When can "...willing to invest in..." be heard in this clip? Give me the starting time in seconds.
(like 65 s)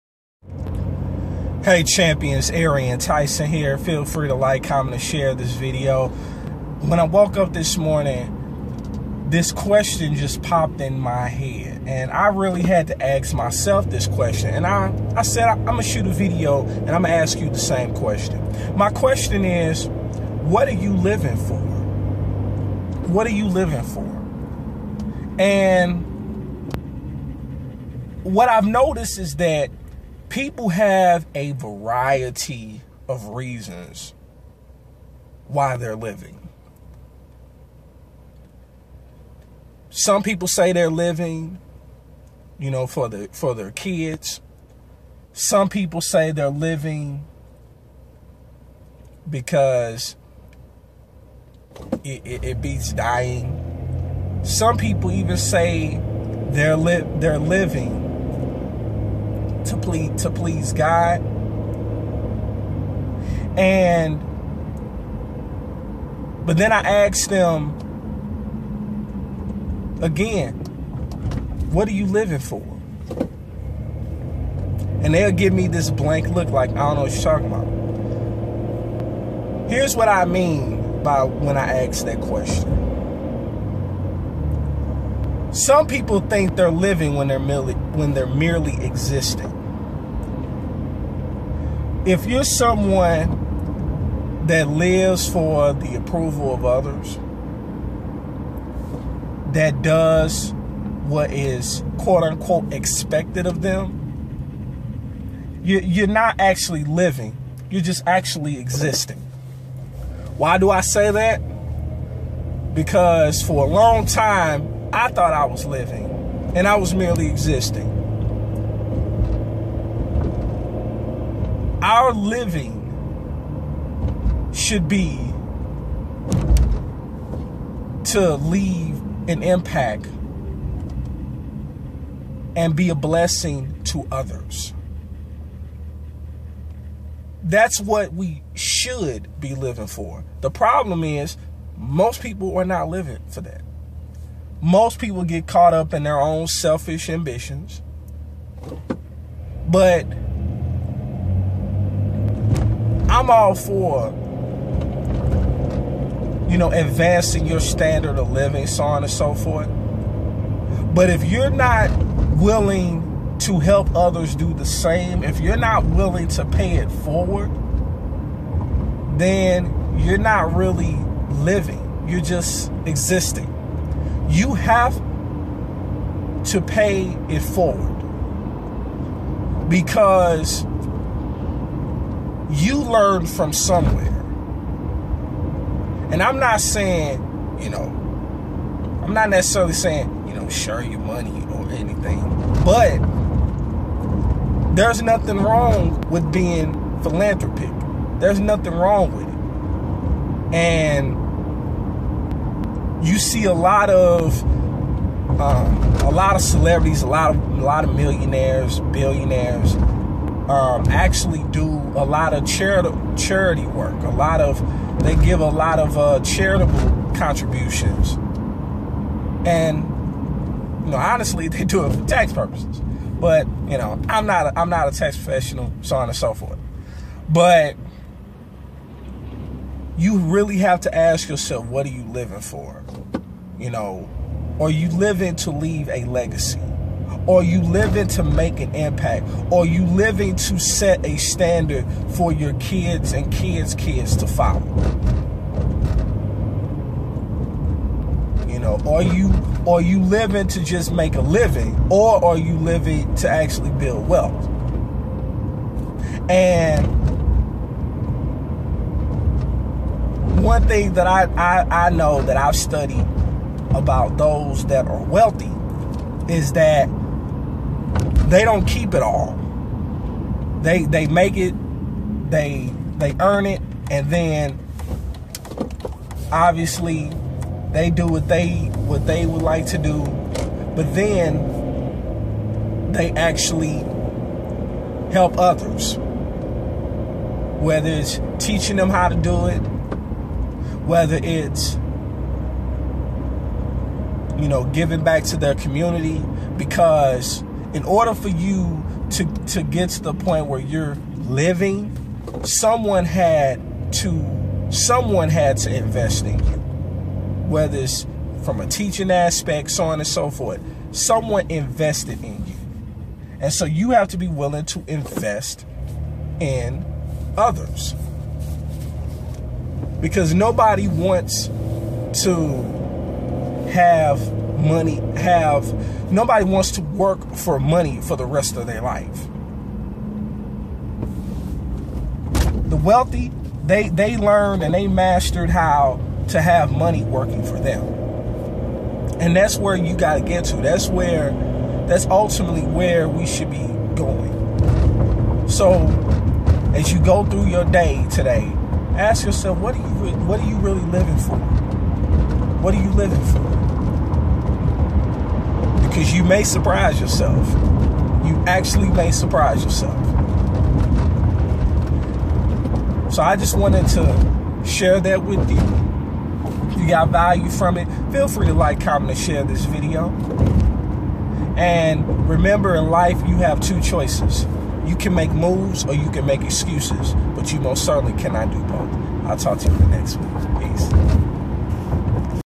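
314 s.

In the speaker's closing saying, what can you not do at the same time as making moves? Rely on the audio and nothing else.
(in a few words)
make excuses.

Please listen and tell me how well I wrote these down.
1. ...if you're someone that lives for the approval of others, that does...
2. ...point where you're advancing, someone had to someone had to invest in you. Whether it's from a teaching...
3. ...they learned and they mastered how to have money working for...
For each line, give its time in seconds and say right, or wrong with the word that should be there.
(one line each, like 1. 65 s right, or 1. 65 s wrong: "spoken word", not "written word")
1. 92 s right
2. 300 s wrong: "living", not "advancing"
3. 333 s right.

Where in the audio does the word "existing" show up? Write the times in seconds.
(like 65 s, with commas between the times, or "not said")
88 s, 108 s, 117 s, 172 s.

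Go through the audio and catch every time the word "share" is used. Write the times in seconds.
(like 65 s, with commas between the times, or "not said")
5 s, 190 s, 364 s, 369 s.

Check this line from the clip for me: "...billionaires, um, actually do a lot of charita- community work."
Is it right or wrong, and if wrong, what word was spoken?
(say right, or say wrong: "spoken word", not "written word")
wrong: "charity", not "community".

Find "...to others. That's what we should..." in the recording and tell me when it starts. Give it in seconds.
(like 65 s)
133 s.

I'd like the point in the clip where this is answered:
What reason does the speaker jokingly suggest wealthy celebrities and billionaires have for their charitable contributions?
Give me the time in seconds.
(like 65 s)
222 s.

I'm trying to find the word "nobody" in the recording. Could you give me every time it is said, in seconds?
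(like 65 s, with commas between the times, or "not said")
320 s, 326 s.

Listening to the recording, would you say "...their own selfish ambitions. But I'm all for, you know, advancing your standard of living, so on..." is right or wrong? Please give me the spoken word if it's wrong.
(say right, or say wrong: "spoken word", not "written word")
right.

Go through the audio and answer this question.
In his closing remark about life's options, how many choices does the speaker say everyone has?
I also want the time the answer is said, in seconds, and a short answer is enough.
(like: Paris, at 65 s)
2, at 373 s.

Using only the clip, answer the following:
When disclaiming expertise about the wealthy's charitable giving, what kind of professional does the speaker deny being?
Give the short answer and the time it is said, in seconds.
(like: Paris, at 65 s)
tax professional, at 224 s.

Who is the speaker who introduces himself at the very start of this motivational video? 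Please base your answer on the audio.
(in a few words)
Arian Tyson.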